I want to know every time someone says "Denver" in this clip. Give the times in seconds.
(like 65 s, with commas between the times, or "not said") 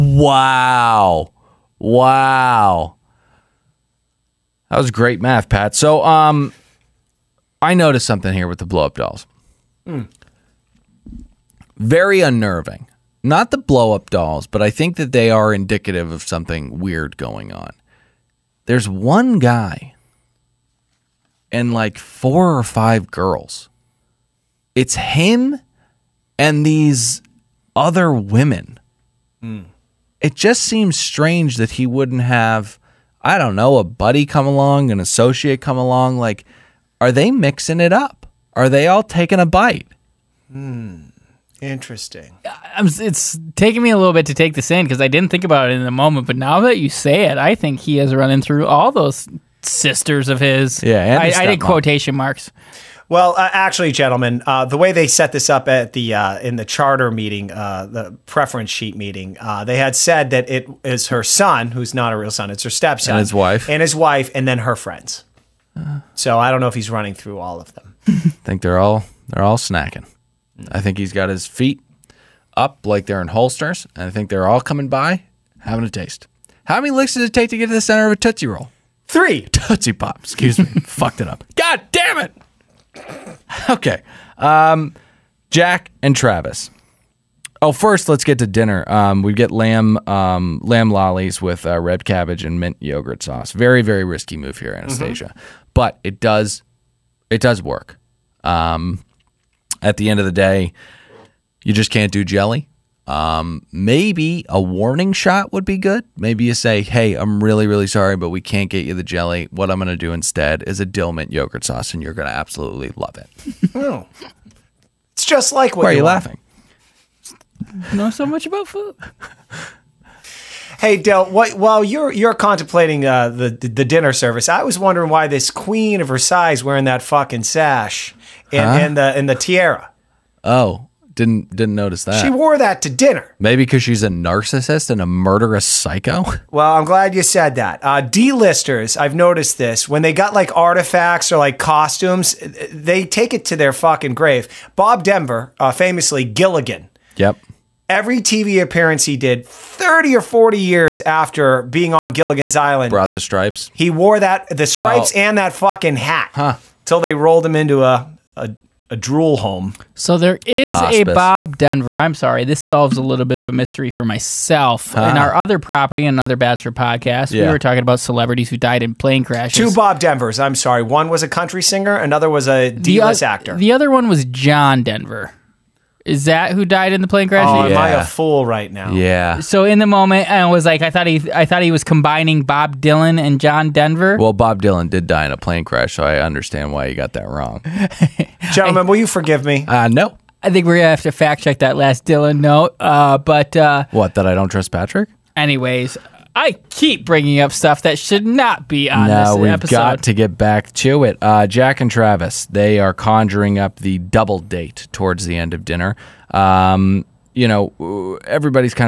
145 s, 161 s, 169 s, 174 s, 183 s.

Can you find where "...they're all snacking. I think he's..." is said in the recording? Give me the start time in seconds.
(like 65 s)
69 s.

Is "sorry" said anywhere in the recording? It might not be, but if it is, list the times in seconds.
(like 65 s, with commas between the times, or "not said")
107 s, 162 s, 170 s.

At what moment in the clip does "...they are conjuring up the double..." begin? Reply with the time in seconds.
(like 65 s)
202 s.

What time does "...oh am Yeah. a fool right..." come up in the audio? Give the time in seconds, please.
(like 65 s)
177 s.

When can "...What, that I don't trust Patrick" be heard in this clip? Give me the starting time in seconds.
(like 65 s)
193 s.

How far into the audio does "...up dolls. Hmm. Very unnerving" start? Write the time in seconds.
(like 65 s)
8 s.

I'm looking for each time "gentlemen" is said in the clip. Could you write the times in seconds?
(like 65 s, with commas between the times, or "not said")
53 s, 188 s.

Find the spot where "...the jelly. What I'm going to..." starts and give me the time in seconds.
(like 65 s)
108 s.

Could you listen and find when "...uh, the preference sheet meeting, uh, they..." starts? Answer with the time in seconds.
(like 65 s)
57 s.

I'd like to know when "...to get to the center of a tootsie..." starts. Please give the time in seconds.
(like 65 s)
77 s.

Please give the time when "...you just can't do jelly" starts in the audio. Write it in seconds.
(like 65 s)
101 s.